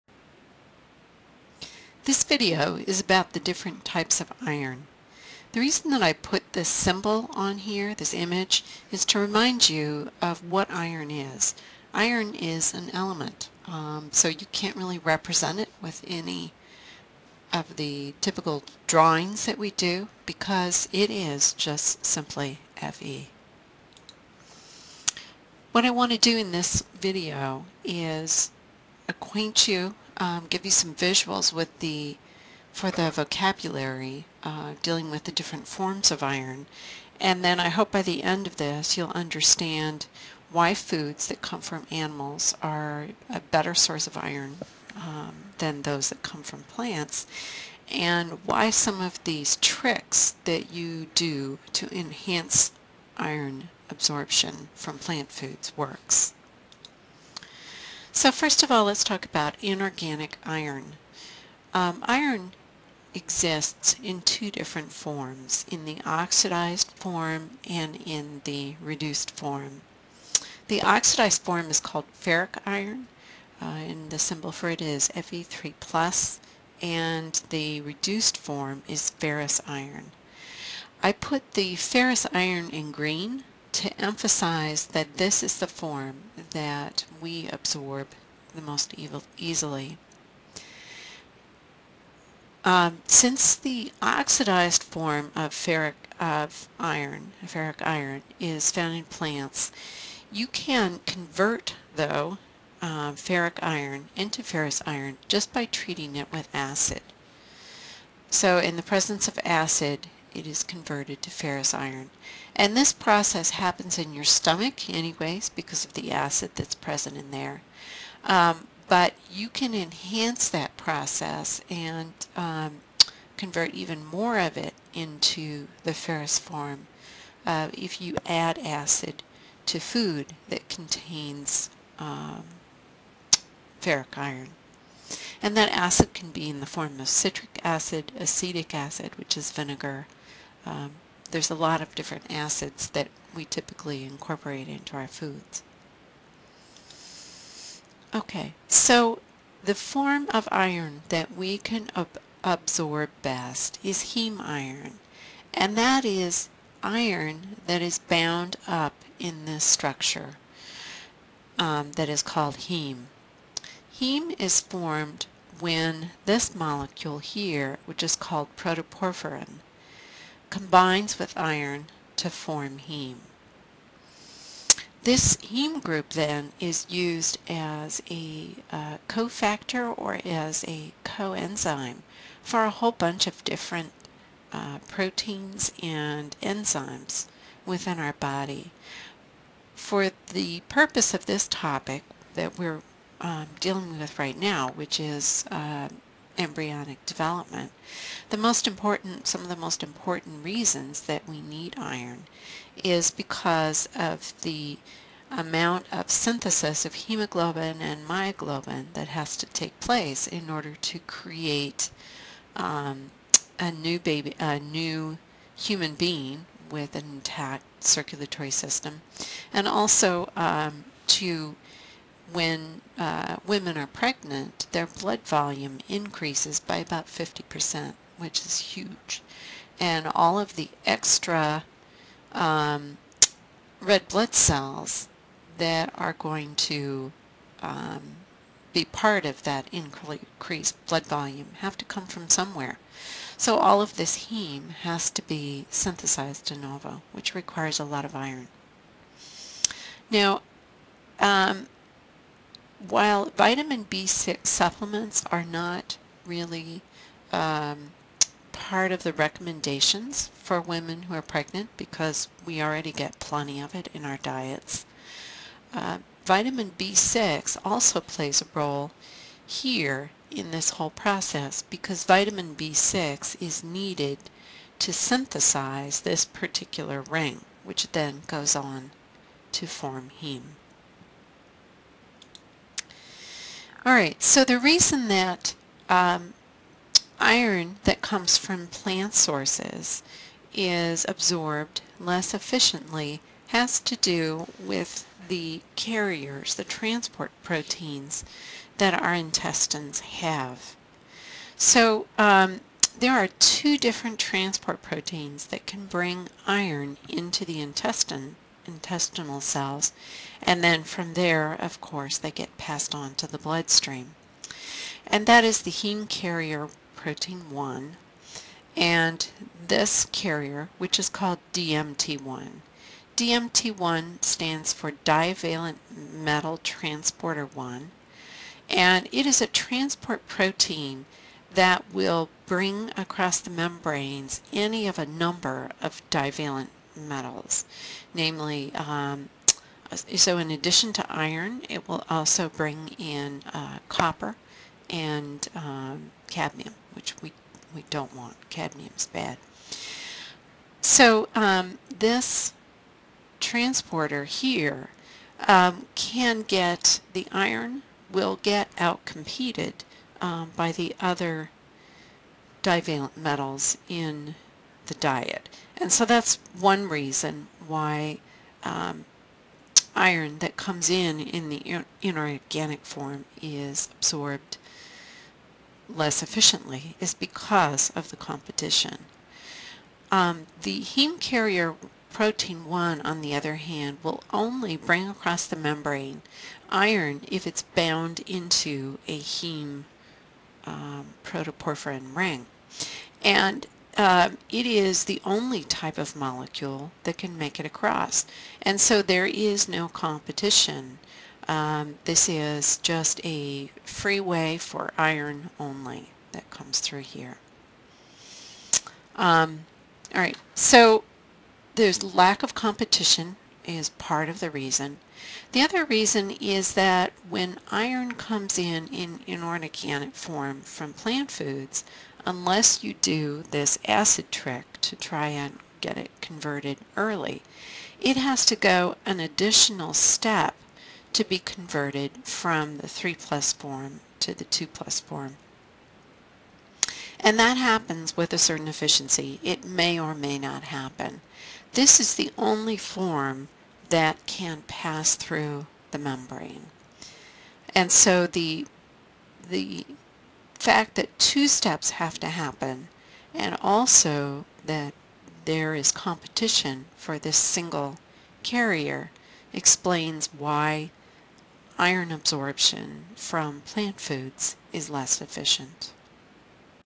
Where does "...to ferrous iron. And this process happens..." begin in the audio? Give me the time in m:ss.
1:51.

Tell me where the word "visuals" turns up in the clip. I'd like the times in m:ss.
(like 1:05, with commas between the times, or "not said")
0:30.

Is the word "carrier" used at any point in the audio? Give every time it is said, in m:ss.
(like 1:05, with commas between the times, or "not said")
4:55, 5:16, 5:20, 6:21, 7:38.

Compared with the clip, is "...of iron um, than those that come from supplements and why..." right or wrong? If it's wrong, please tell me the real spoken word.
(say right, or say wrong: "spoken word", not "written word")
wrong: "plants", not "supplements".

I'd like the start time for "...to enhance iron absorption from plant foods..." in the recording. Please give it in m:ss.
0:51.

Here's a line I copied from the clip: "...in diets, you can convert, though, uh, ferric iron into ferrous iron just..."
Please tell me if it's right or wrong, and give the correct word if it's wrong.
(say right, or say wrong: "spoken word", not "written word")
wrong: "plants", not "diets".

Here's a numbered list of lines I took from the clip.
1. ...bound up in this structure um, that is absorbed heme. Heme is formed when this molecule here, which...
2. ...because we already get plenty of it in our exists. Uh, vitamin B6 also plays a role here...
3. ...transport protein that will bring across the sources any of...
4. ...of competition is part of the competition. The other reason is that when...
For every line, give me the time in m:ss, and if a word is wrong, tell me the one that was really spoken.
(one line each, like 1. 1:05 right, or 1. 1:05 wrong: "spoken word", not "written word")
1. 2:37 wrong: "called", not "absorbed"
2. 4:21 wrong: "diets", not "exists"
3. 5:29 wrong: "membranes", not "sources"
4. 6:52 wrong: "reason", not "competition".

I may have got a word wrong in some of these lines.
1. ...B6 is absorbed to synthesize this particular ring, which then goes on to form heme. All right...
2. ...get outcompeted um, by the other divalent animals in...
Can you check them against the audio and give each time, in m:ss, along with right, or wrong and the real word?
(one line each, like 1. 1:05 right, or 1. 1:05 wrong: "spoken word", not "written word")
1. 4:32 wrong: "needed", not "absorbed"
2. 5:58 wrong: "metals", not "animals".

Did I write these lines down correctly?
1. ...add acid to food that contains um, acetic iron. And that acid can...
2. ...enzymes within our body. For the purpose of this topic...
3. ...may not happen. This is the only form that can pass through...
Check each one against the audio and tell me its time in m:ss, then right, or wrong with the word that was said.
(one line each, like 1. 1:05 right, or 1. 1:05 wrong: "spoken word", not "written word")
1. 2:08 wrong: "ferric", not "acetic"
2. 3:06 right
3. 7:20 right.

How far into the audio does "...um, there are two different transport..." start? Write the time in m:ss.
5:02.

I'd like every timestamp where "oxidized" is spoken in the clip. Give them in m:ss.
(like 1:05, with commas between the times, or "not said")
1:06, 1:10, 1:34.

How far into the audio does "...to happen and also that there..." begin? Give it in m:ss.
7:32.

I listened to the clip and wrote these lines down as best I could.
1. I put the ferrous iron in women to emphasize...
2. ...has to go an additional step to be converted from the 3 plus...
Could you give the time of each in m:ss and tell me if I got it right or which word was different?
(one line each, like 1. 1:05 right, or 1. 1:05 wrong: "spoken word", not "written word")
1. 1:21 wrong: "green", not "women"
2. 7:08 right.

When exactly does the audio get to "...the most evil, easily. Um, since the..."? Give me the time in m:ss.
1:28.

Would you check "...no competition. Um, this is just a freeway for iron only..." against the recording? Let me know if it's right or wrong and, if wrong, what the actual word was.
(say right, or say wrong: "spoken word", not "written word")
right.